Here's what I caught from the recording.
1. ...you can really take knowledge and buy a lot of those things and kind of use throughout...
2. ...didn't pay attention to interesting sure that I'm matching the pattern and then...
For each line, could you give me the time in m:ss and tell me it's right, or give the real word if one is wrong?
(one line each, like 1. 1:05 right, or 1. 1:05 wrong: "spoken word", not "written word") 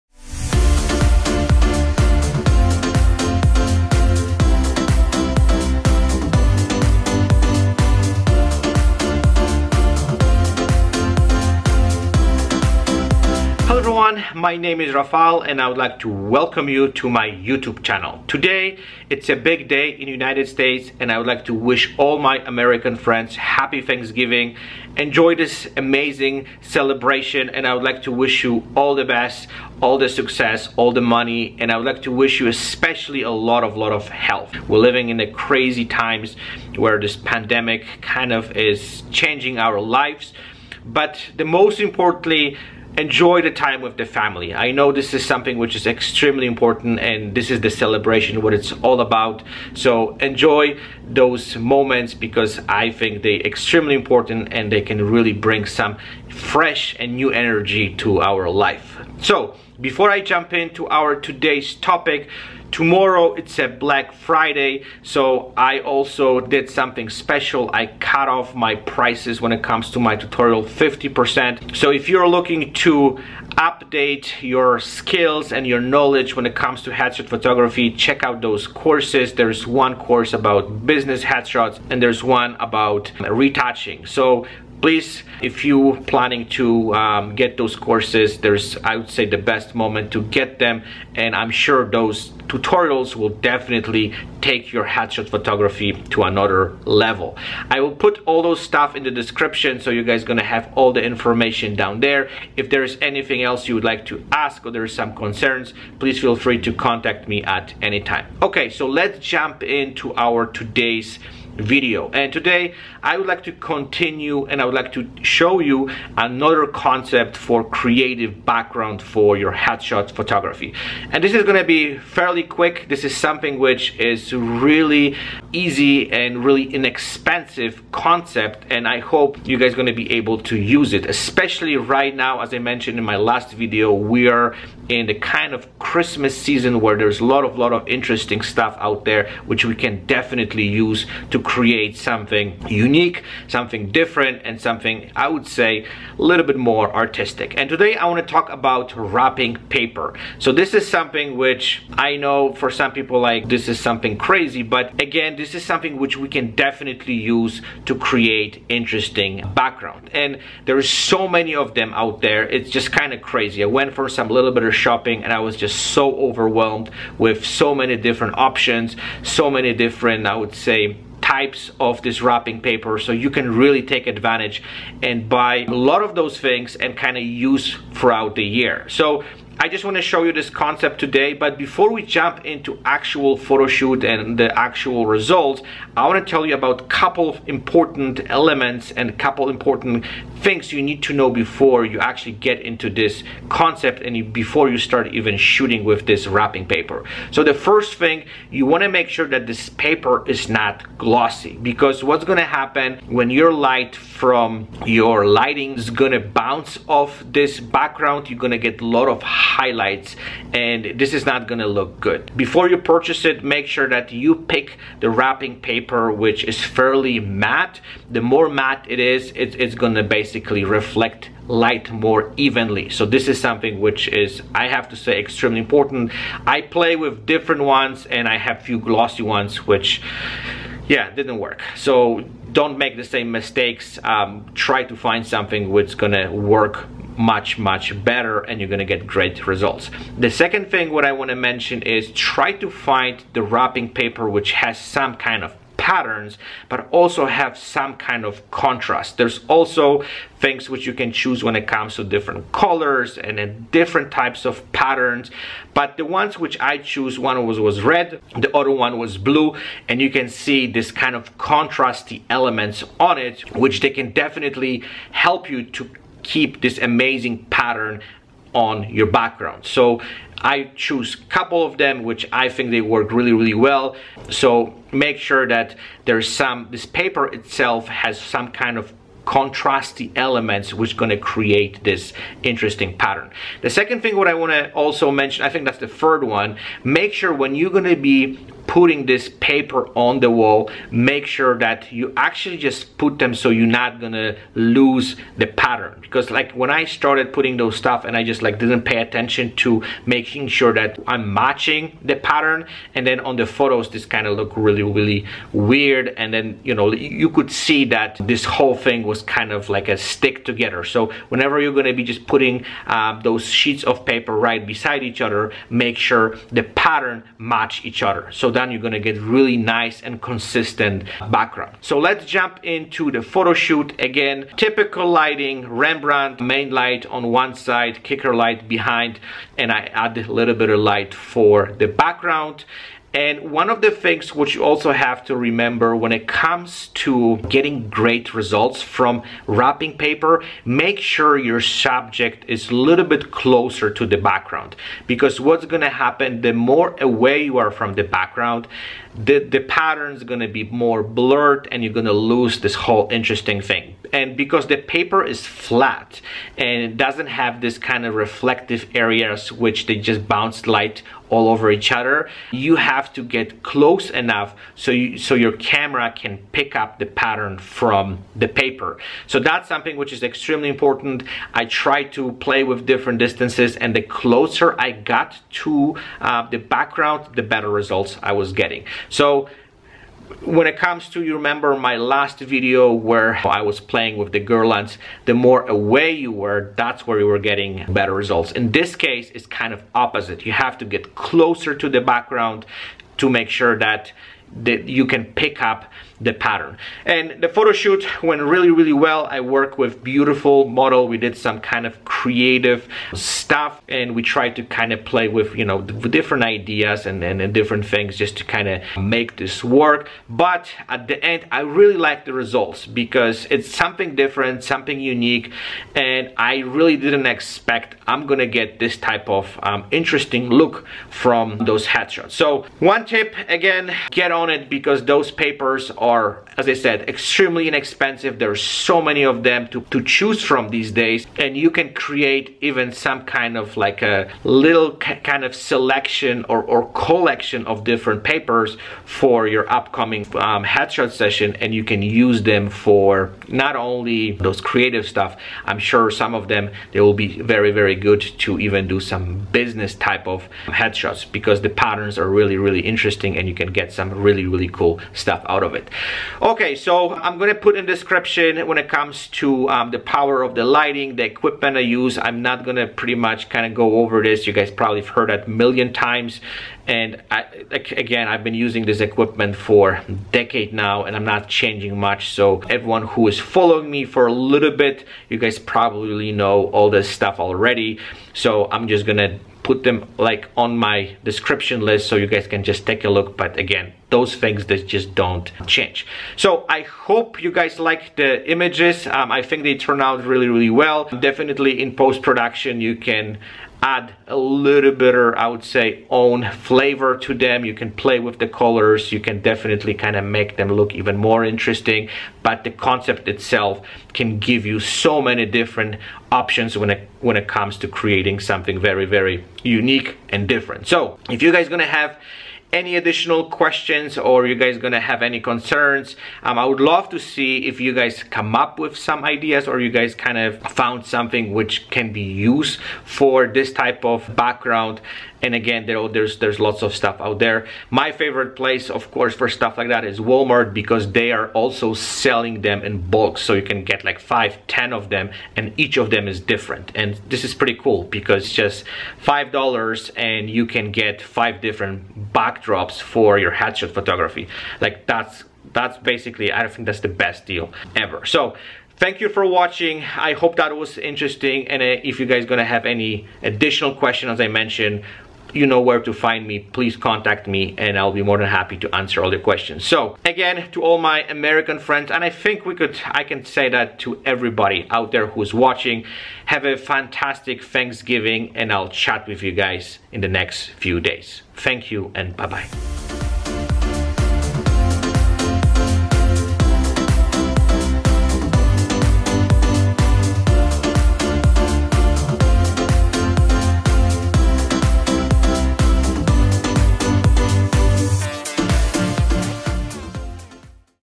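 1. 2:53 wrong: "advantage", not "knowledge"
2. 4:58 wrong: "making", not "interesting".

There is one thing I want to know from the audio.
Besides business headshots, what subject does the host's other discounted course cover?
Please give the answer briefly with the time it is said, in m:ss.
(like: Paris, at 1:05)
Retouching, at 1:23.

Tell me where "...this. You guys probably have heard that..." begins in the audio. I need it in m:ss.
7:44.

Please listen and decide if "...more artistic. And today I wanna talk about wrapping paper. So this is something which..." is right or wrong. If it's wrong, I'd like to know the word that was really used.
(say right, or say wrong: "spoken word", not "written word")
right.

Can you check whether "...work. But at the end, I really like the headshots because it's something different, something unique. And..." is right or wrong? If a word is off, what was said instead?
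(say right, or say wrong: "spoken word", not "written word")
wrong: "results", not "headshots".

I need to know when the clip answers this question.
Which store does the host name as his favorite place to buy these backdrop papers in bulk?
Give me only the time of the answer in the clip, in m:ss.
8:50.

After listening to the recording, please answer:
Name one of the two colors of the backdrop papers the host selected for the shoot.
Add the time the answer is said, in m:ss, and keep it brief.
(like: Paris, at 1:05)
Red, at 4:17.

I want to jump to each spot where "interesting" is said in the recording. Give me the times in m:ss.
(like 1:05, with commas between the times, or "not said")
2:17, 2:38, 4:42, 5:53, 6:59, 7:32, 8:21, 9:10.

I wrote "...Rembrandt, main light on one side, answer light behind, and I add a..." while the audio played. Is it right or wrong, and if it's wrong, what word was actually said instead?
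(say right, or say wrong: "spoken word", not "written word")
wrong: "kicker", not "answer".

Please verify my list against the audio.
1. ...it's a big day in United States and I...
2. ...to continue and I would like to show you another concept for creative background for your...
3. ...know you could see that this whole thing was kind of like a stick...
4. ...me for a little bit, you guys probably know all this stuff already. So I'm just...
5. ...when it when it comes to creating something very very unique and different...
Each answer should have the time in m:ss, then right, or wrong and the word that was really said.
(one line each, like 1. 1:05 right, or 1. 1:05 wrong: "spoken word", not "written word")
1. 0:19 right
2. 1:53 right
3. 5:06 right
4. 7:53 right
5. 8:26 right.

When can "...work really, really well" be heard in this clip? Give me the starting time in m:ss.
4:32.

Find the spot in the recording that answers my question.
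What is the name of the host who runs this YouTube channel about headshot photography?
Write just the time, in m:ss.
0:14.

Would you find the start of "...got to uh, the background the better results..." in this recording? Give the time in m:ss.
6:14.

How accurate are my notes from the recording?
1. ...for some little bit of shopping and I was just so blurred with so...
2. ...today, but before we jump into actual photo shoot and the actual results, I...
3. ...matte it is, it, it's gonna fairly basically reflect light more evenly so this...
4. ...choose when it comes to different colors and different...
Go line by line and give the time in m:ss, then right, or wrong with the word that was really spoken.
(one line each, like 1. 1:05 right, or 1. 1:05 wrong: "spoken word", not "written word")
1. 2:43 wrong: "overwhelmed", not "blurred"
2. 3:00 right
3. 3:38 wrong: "basically", not "fairly"
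4. 4:11 right.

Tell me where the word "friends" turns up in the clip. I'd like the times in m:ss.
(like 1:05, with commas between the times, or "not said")
0:22, 9:21.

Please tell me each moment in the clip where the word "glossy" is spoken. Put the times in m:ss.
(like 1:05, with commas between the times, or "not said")
3:20, 3:48.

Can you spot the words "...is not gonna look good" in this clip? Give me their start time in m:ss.
3:31.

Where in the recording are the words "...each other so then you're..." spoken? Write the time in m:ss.
5:17.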